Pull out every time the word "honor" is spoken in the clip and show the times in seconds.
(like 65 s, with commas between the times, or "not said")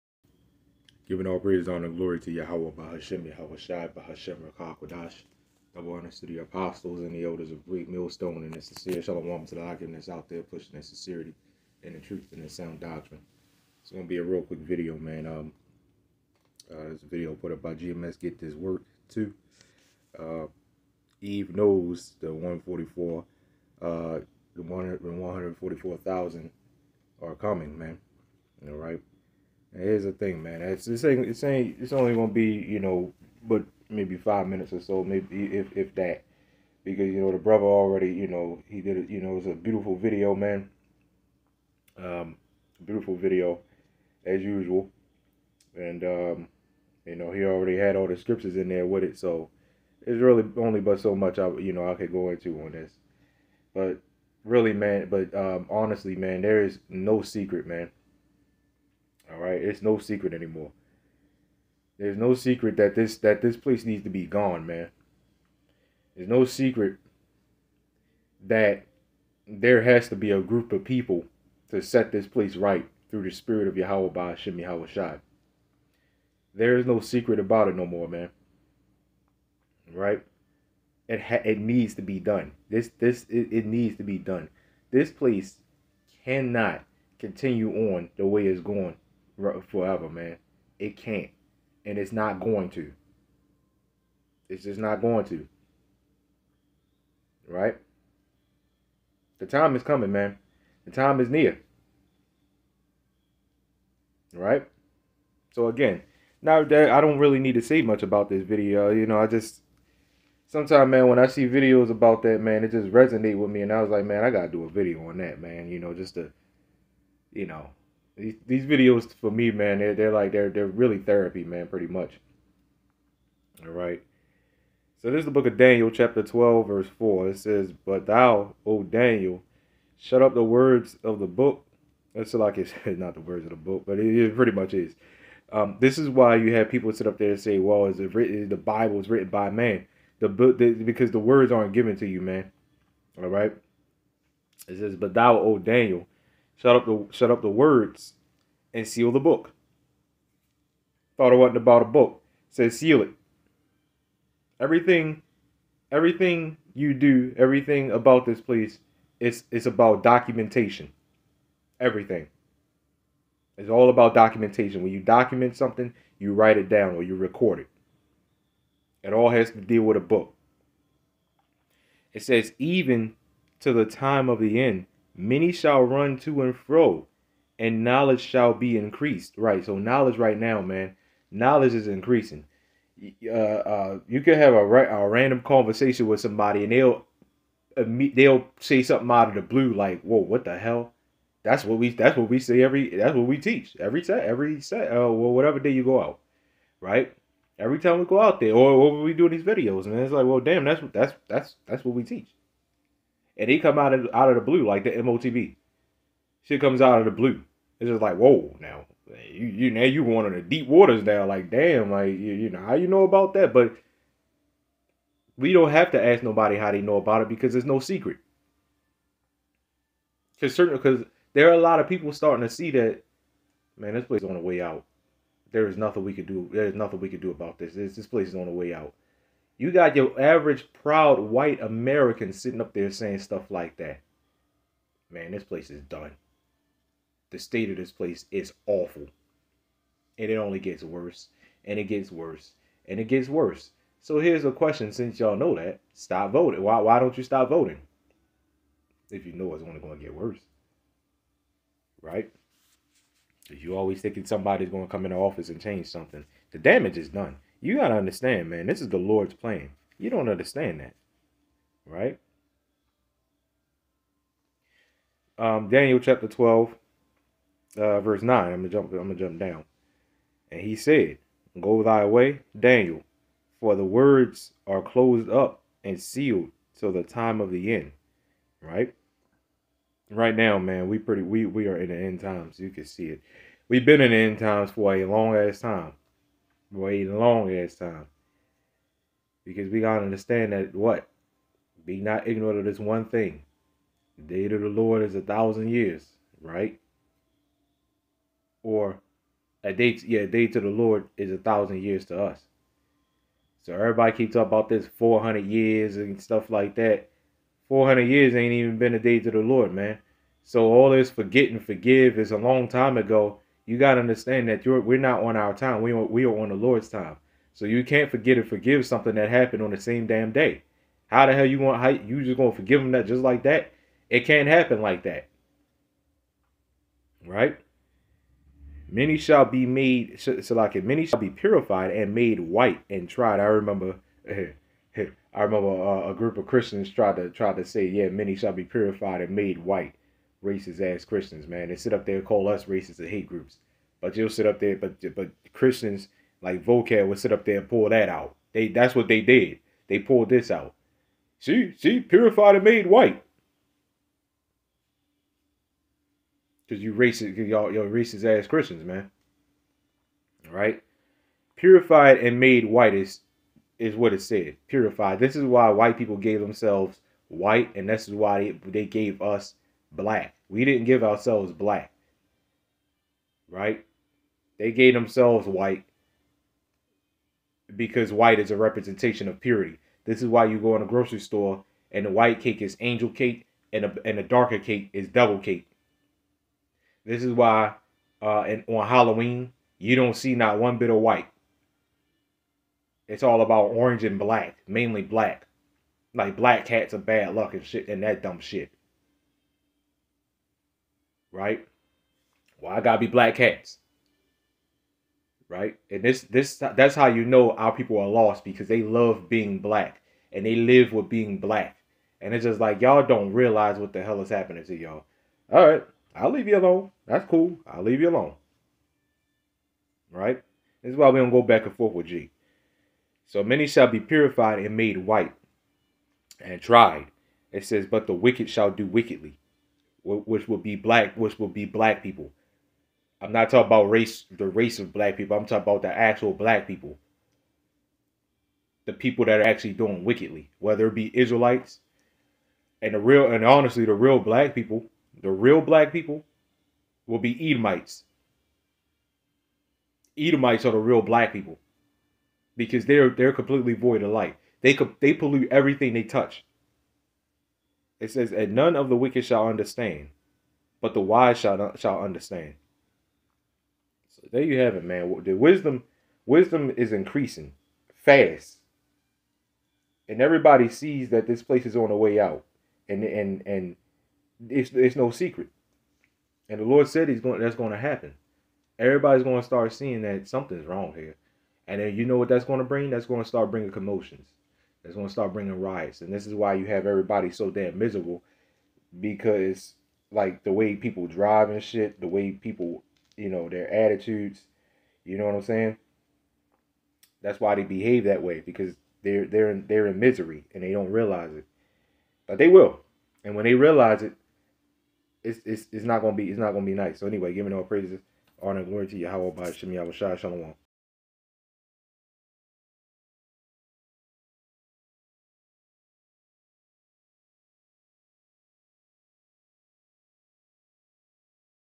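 1 s, 5 s, 508 s.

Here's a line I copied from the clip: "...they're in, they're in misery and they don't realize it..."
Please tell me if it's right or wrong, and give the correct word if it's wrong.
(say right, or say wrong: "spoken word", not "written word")
right.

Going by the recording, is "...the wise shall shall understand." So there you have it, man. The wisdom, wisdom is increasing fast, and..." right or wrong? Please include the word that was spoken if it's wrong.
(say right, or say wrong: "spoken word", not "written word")
right.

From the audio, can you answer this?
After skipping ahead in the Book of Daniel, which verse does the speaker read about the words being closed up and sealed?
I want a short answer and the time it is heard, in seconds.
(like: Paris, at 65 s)
verse 9, at 268 s.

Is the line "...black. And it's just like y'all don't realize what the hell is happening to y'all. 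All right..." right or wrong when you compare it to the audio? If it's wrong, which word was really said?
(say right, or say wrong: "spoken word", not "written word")
right.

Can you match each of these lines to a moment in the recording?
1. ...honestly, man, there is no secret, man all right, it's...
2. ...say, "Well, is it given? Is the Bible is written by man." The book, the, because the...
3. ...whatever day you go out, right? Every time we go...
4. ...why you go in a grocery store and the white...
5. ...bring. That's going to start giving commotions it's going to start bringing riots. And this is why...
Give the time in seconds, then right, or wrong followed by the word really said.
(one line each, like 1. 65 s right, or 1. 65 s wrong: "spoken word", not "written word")
1. 55 s right
2. 137 s wrong: "written", not "given"
3. 195 s right
4. 380 s right
5. 482 s wrong: "bringing", not "giving".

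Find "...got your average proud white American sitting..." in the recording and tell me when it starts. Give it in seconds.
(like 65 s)
229 s.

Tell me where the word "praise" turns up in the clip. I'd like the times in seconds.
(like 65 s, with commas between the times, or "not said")
1 s, 507 s.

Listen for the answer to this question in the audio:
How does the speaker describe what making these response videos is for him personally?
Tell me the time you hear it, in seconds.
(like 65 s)
120 s.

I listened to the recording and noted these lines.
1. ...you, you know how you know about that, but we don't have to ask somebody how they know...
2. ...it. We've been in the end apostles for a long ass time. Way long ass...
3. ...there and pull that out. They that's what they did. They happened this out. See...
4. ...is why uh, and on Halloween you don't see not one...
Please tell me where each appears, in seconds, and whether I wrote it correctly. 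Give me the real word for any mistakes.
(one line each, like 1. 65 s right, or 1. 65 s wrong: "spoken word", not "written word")
1. 212 s wrong: "nobody", not "somebody"
2. 283 s wrong: "times", not "apostles"
3. 347 s wrong: "pulled", not "happened"
4. 387 s right.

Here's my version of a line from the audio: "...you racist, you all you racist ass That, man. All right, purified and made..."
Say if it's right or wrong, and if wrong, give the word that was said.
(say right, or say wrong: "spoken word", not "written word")
wrong: "Christians", not "That".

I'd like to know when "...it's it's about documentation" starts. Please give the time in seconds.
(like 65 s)
159 s.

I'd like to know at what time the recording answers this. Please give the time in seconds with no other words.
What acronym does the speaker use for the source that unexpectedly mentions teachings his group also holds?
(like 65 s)
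204 s.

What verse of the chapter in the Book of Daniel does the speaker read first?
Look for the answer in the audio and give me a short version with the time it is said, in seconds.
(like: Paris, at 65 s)
verse 4, at 126 s.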